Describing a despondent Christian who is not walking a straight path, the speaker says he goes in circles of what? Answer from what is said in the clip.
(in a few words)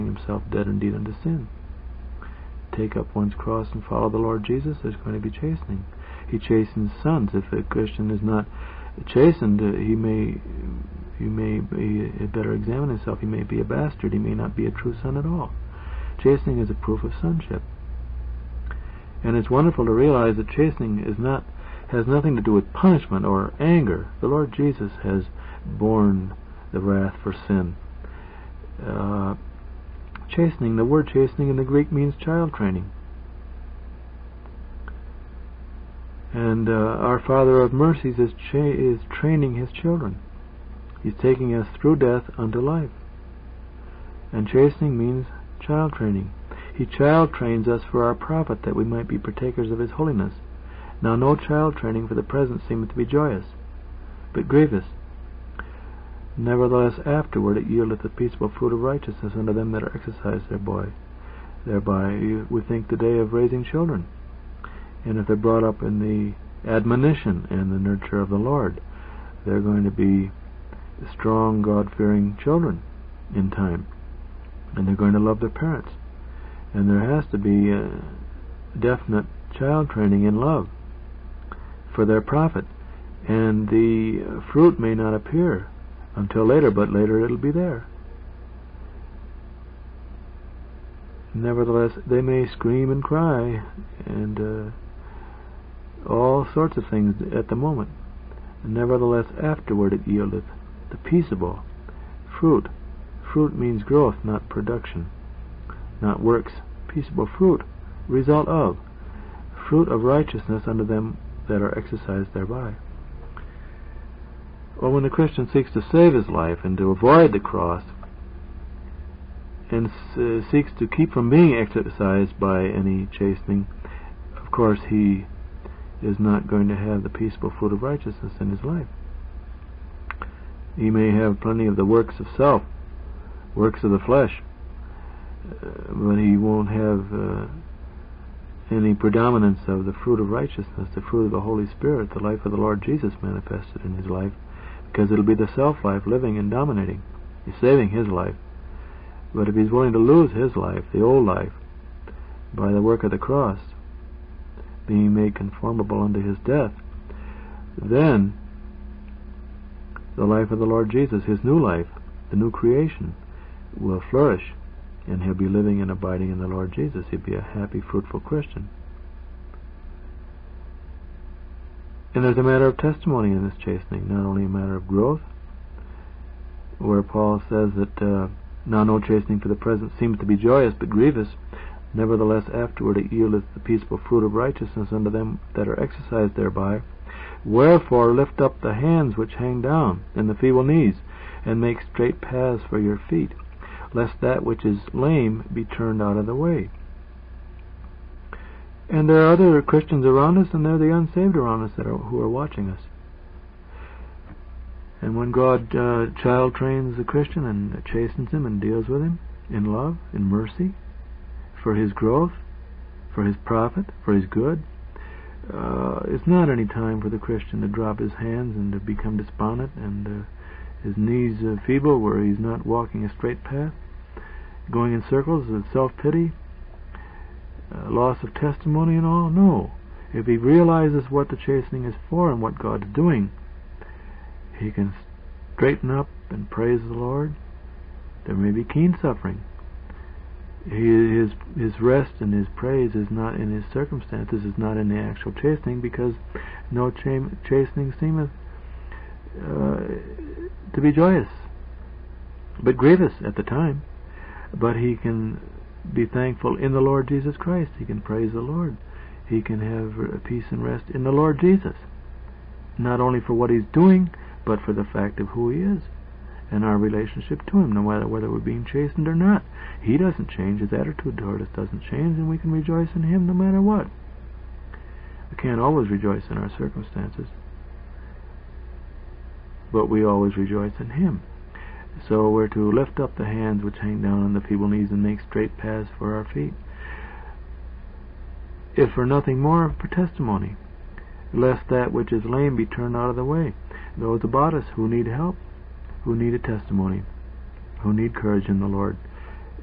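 Self-pity.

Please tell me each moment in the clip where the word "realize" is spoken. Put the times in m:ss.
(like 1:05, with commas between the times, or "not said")
0:19, 3:50.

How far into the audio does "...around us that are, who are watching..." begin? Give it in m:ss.
3:21.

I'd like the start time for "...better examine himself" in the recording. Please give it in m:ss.
0:12.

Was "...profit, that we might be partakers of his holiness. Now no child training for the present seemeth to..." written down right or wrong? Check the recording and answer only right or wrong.
right.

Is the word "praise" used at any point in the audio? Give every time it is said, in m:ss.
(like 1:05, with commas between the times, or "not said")
3:56, 4:02, 4:18.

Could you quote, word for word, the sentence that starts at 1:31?
Nevertheless, they may scream and cry and uh, all sorts of things at the moment.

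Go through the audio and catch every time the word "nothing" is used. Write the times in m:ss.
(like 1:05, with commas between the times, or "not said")
0:22, 4:49.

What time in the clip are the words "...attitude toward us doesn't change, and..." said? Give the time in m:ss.
4:30.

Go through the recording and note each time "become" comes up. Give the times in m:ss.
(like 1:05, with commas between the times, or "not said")
3:38.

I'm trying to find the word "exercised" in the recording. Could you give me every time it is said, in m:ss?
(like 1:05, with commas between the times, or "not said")
0:59, 1:51, 2:01, 3:05.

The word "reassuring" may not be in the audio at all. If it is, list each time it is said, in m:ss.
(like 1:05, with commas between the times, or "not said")
not said.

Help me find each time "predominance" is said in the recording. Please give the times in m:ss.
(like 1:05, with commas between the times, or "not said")
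2:18.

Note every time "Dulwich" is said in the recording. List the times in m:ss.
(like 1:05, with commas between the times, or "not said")
not said.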